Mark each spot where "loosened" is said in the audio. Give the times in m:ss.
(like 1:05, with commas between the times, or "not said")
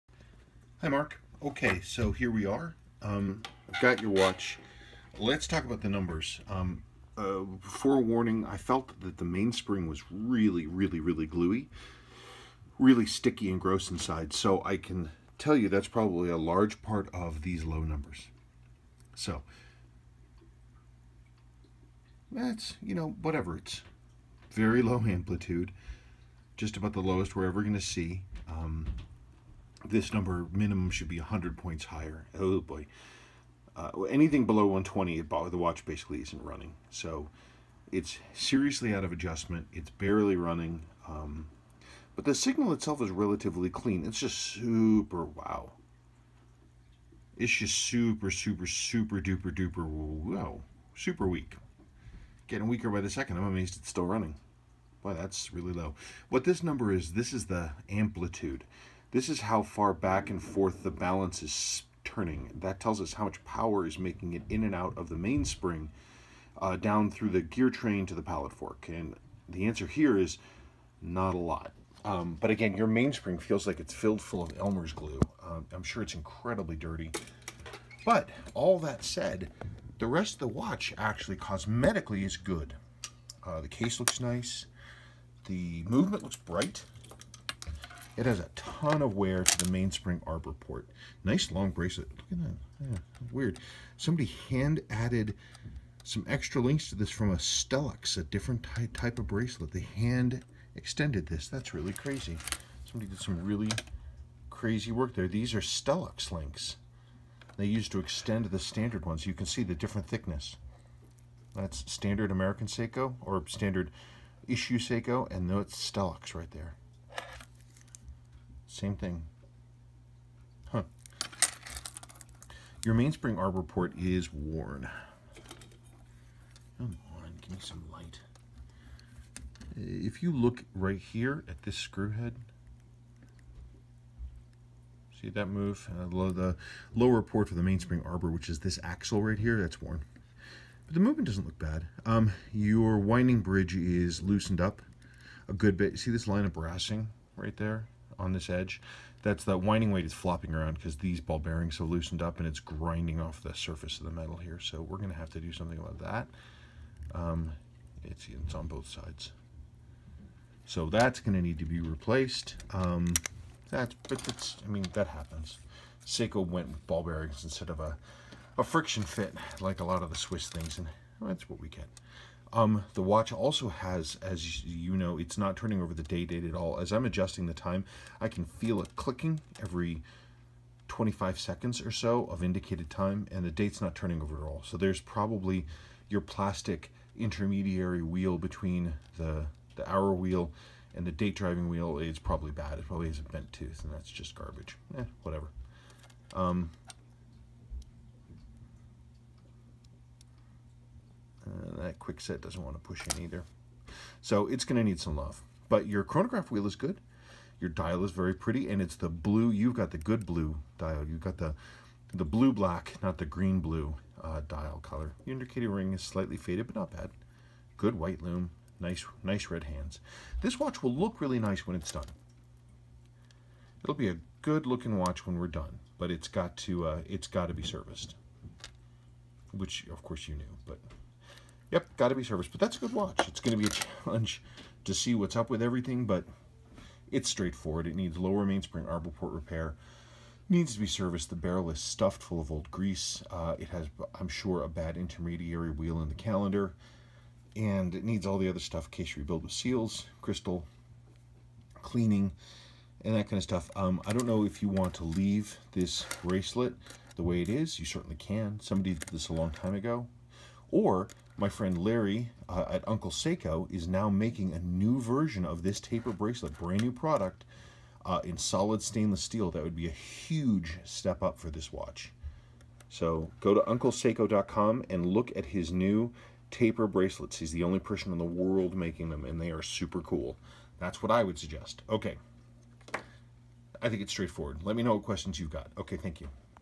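2:24, 2:31.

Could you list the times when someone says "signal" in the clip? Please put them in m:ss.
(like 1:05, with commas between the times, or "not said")
0:42.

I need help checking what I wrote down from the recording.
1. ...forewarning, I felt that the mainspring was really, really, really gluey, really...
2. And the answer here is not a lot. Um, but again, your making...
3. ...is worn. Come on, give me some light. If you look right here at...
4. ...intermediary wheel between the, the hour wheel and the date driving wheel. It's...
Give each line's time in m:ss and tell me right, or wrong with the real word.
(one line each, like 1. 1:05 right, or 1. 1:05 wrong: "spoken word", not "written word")
1. 0:07 right
2. 1:08 wrong: "mainspring", not "making"
3. 2:03 right
4. 3:07 right.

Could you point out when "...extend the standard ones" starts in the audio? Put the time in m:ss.
1:47.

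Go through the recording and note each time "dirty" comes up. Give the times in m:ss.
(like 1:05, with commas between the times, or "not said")
1:16.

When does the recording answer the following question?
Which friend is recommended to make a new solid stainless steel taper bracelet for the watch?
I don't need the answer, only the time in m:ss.
4:21.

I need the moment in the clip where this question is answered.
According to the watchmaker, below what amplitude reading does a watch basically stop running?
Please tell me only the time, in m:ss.
0:34.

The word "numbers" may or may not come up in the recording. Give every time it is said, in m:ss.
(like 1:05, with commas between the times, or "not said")
0:05, 0:17, 0:30, 0:56.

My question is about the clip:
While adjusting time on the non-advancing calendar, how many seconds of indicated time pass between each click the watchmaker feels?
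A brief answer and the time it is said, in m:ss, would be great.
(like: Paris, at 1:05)
25 seconds, at 3:00.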